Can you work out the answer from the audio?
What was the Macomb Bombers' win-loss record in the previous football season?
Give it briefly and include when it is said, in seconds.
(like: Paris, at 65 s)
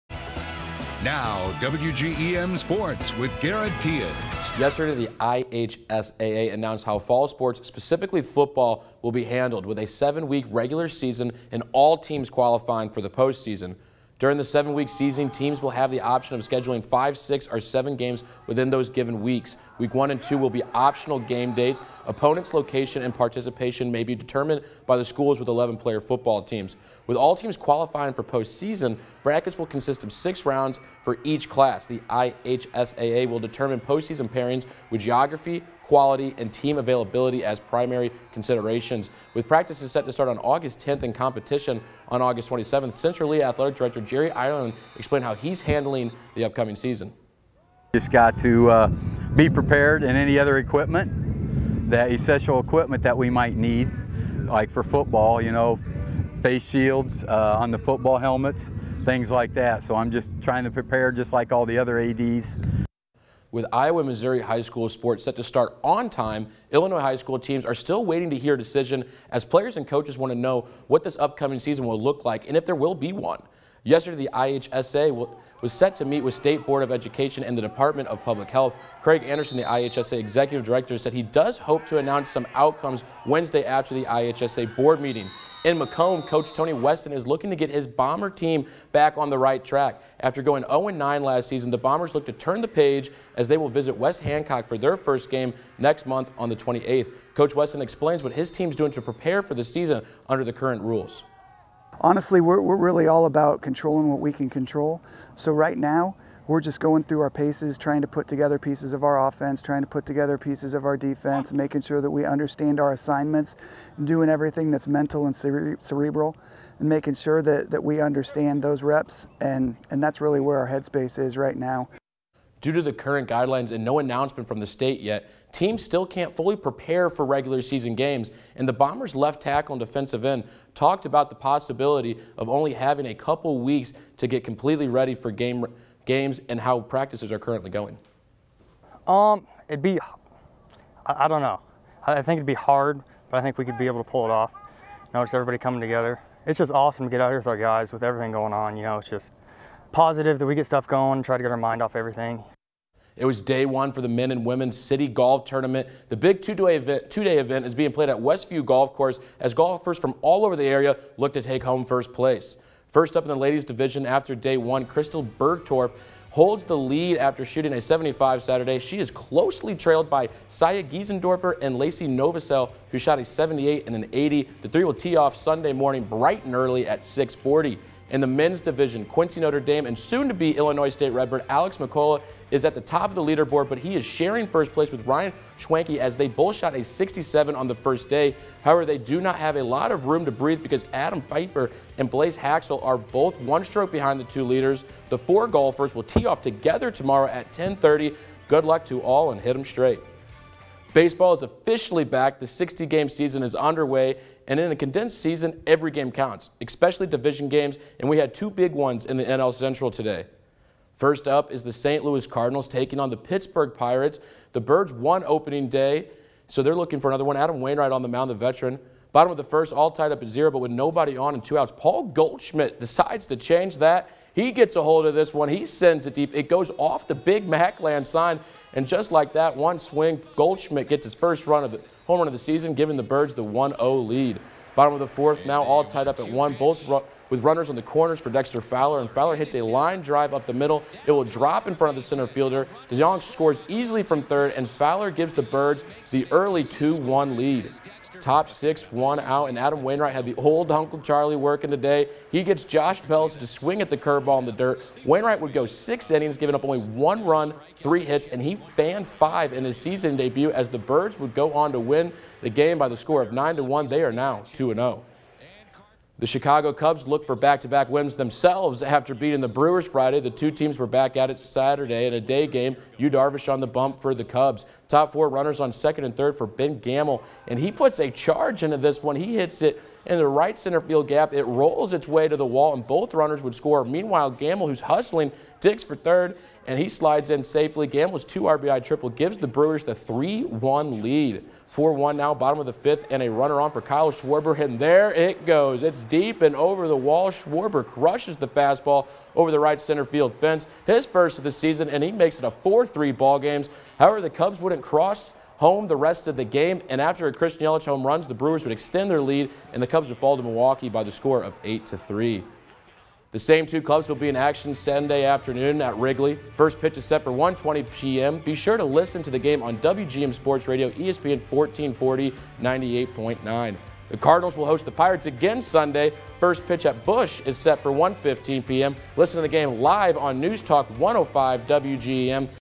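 0-9, at 90 s.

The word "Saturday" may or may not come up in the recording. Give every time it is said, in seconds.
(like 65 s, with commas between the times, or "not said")
168 s, 271 s.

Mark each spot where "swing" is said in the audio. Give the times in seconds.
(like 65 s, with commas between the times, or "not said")
229 s, 253 s.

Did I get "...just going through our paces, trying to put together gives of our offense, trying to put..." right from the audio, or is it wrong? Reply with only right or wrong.
wrong.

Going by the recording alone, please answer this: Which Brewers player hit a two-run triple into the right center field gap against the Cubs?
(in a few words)
Ben Gamel.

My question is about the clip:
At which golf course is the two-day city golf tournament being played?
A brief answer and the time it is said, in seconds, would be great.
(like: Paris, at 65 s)
Westview Golf Course, at 158 s.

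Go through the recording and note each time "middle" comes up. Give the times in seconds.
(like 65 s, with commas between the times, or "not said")
240 s.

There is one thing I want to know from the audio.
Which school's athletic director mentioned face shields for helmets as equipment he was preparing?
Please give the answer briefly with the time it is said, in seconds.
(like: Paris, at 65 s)
Central Lee, at 42 s.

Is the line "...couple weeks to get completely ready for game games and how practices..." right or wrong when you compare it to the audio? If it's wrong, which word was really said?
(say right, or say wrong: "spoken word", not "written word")
right.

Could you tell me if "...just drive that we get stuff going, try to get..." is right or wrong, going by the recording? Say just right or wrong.
wrong.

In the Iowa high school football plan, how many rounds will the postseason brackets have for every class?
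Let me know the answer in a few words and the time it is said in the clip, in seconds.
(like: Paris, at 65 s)
6, at 30 s.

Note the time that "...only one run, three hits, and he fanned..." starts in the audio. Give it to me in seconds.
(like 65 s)
256 s.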